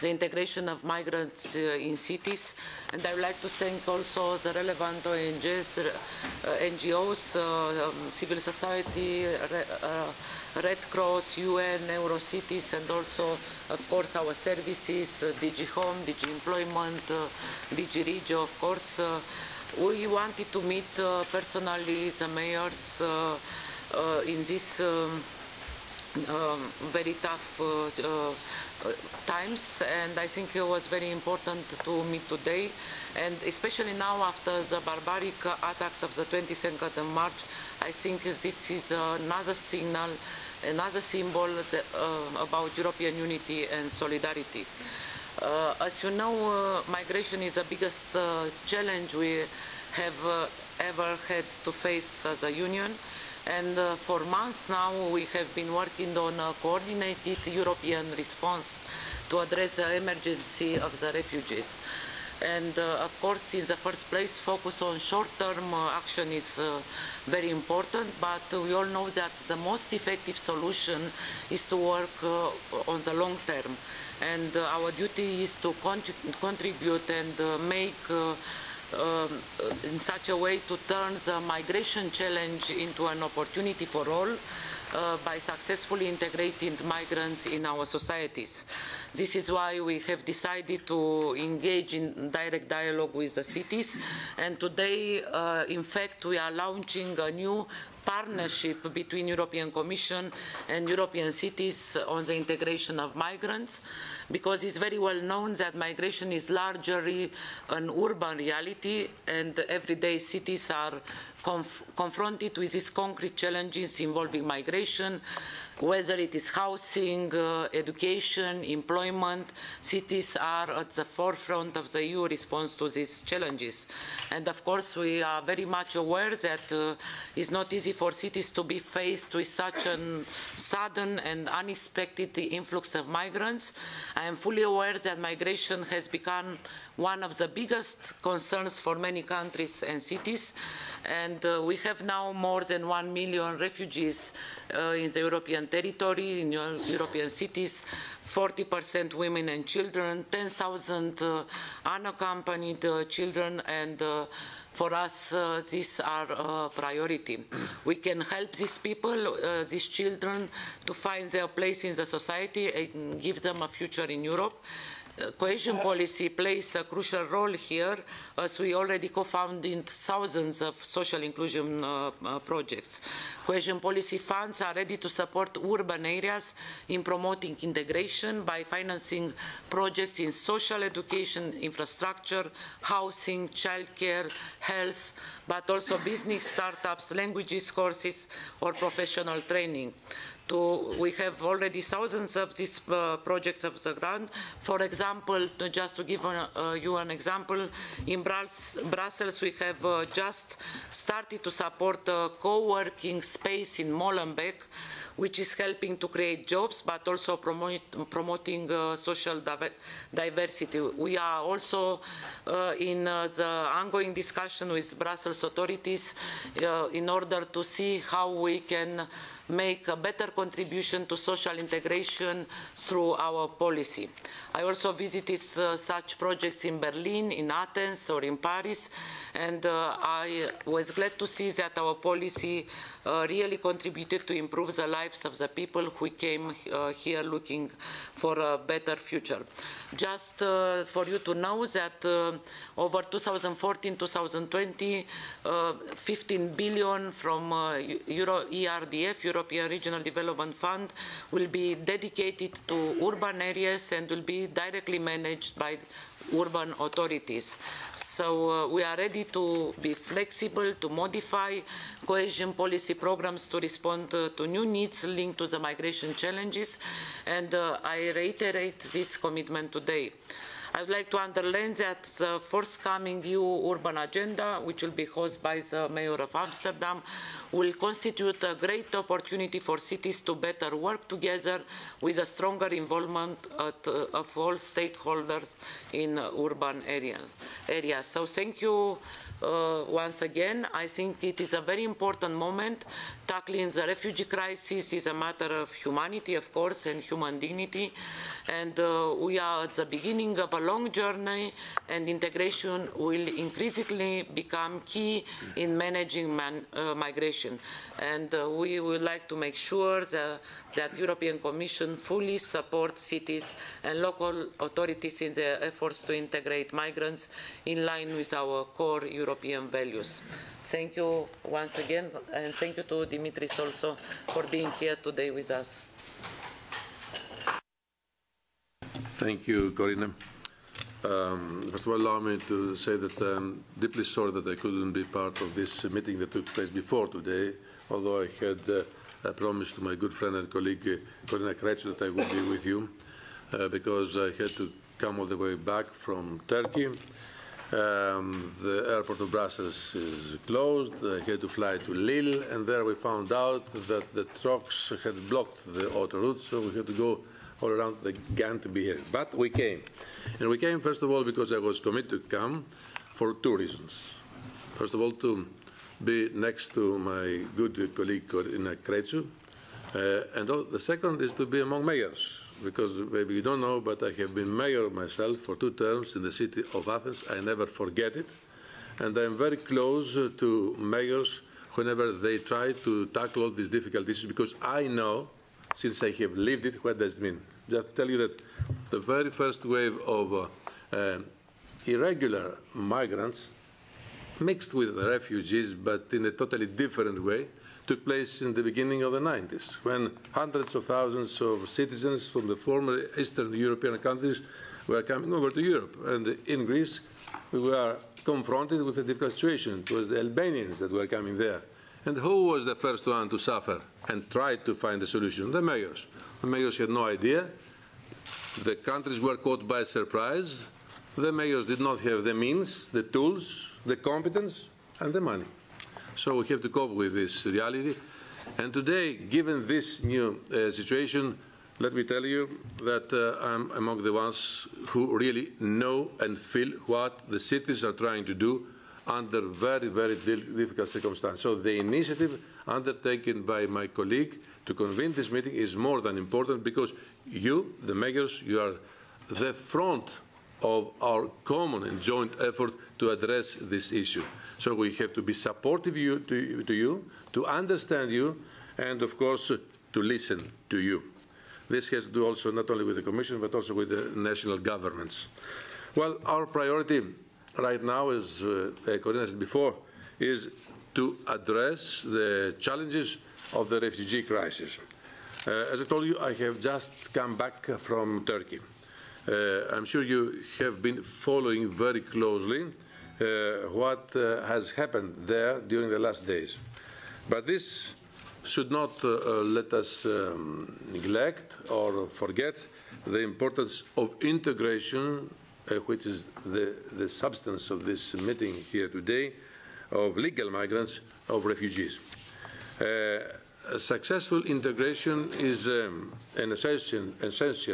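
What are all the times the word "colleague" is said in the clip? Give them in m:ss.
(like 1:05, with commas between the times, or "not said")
5:40, 6:07, 7:23.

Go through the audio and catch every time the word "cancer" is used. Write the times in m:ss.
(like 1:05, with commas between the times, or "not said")
not said.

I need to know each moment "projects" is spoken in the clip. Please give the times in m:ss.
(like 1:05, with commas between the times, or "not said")
2:52, 2:59, 3:13, 3:46.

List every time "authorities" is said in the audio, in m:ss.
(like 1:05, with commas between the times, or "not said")
3:35, 4:16, 5:14.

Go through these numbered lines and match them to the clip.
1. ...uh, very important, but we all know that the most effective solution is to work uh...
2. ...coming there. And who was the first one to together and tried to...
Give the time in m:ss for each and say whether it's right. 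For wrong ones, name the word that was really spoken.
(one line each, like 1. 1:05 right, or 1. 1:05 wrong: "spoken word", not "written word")
1. 1:06 right
2. 6:51 wrong: "suffer", not "together".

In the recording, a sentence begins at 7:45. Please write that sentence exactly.
Well, our priority right now, as uh, said before, is to address the challenges of the refugee crisis.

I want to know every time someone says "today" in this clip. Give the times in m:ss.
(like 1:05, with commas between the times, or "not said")
0:32, 1:34, 4:29, 5:24, 5:37, 7:08, 8:18.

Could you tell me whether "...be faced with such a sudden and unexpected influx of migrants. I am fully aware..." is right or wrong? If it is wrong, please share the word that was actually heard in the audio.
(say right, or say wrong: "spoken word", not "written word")
right.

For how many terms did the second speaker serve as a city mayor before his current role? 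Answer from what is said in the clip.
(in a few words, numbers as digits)
2.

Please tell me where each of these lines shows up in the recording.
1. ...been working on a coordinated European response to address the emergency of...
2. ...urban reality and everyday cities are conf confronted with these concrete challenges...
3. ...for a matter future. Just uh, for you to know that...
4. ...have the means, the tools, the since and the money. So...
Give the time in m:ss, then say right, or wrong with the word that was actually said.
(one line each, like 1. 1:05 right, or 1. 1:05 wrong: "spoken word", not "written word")
1. 0:55 right
2. 1:47 right
3. 3:58 wrong: "better", not "matter"
4. 7:01 wrong: "competence", not "since".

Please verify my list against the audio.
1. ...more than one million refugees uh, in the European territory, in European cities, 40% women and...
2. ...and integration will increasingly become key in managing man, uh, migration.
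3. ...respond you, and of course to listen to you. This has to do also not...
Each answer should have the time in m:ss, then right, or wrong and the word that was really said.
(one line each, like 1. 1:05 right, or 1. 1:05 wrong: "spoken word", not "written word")
1. 2:22 right
2. 5:01 right
3. 7:37 wrong: "understand", not "respond".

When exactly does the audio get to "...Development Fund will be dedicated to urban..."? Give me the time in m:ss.
4:10.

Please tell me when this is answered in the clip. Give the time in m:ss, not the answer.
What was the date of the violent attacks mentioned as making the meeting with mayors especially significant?
0:36.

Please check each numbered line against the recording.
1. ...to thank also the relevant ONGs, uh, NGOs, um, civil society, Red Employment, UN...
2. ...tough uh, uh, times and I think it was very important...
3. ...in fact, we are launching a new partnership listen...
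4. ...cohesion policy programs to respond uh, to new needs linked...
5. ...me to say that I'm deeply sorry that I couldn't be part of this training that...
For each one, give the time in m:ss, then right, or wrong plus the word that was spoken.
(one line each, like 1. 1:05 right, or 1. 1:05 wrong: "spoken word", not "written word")
1. 0:03 wrong: "Cross", not "Employment"
2. 0:27 right
3. 1:35 wrong: "between", not "listen"
4. 4:22 right
5. 5:32 wrong: "meeting", not "training".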